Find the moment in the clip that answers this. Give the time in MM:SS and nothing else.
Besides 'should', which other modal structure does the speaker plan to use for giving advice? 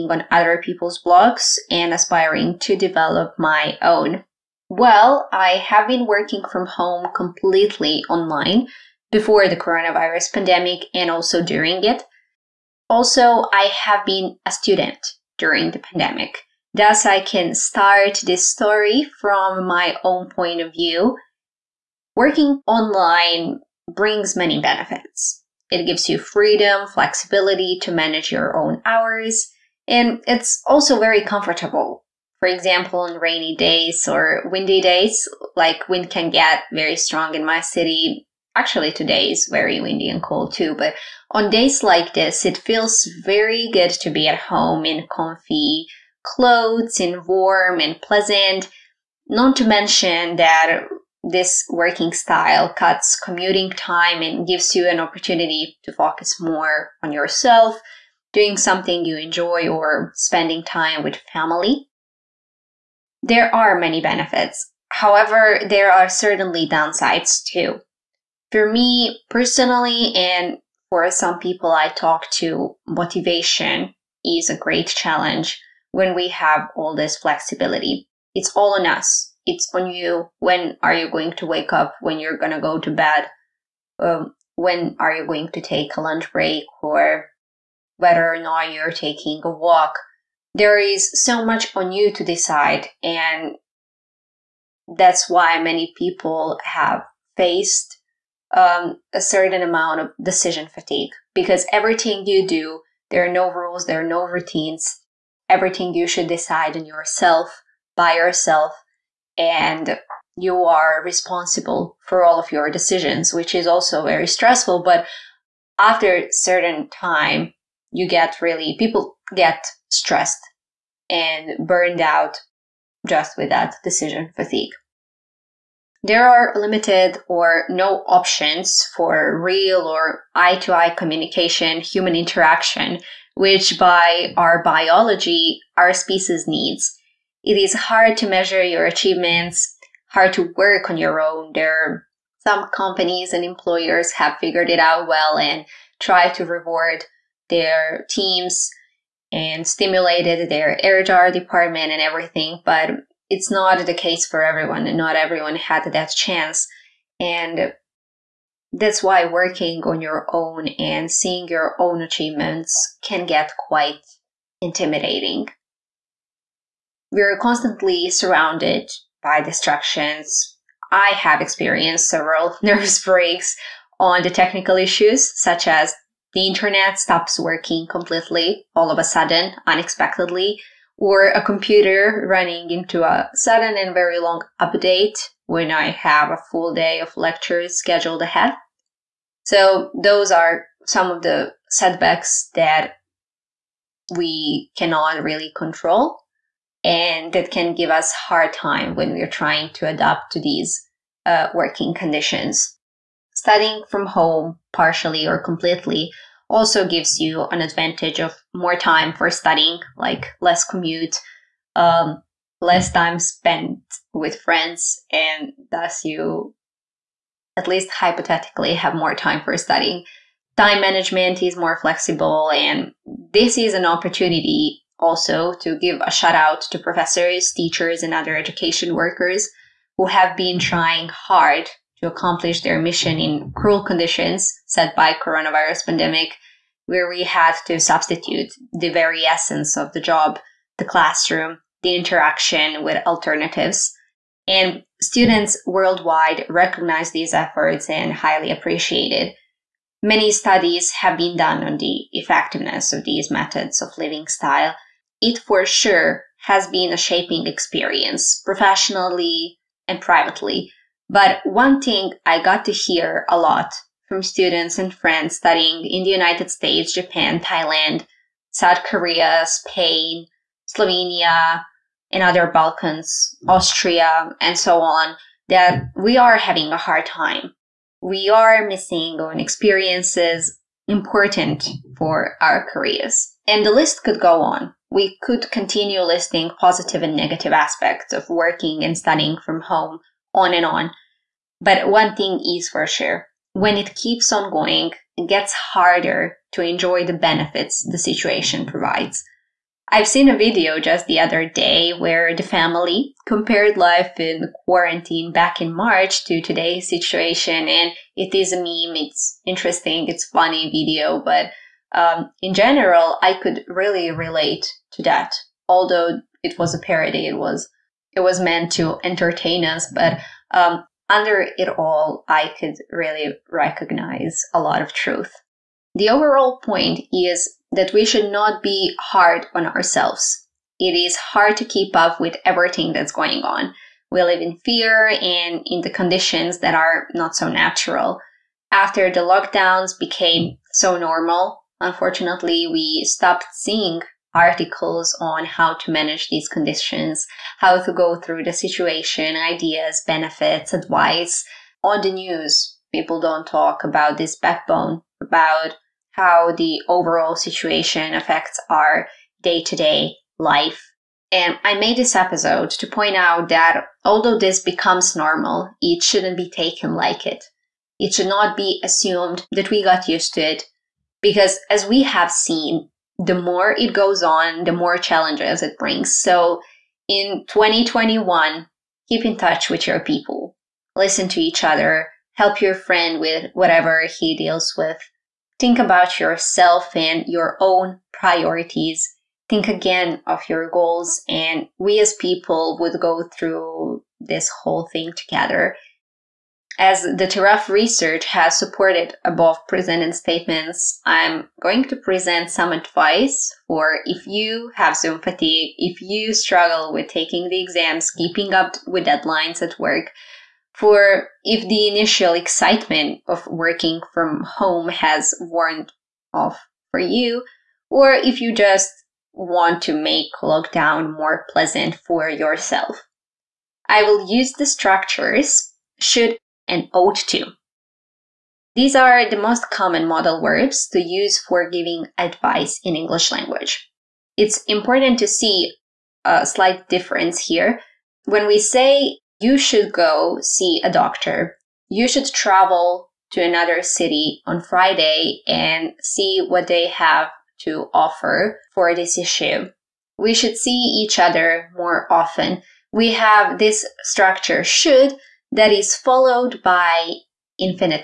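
07:06.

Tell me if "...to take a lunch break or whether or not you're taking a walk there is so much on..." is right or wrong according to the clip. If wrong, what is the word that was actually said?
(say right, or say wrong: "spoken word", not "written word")
right.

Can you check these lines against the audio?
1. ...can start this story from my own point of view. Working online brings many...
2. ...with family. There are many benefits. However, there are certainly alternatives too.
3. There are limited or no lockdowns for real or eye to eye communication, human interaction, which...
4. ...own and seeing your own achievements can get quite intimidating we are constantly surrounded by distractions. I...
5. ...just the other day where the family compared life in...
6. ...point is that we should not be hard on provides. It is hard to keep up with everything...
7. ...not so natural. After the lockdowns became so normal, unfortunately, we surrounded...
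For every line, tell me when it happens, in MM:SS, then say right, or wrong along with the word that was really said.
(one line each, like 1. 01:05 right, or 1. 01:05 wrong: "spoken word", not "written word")
1. 00:17 right
2. 01:01 wrong: "downsides", not "alternatives"
3. 02:06 wrong: "options", not "lockdowns"
4. 02:40 right
5. 05:00 right
6. 05:26 wrong: "ourselves", not "provides"
7. 05:37 wrong: "stopped", not "surrounded".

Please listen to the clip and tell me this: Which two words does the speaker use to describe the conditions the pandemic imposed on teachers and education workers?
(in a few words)
cruel conditions.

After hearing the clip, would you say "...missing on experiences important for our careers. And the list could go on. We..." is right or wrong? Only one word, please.
right.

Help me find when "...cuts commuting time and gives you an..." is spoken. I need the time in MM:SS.
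00:52.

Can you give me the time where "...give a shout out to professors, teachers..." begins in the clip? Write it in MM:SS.
03:45.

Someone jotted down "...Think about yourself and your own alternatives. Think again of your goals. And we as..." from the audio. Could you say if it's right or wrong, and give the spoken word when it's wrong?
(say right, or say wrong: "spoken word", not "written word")
wrong: "priorities", not "alternatives".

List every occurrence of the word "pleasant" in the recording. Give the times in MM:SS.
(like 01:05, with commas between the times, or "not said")
00:47, 07:01.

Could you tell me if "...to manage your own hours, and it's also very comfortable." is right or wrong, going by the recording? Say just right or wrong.
right.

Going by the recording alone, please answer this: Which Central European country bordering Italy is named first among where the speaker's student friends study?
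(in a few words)
Slovenia.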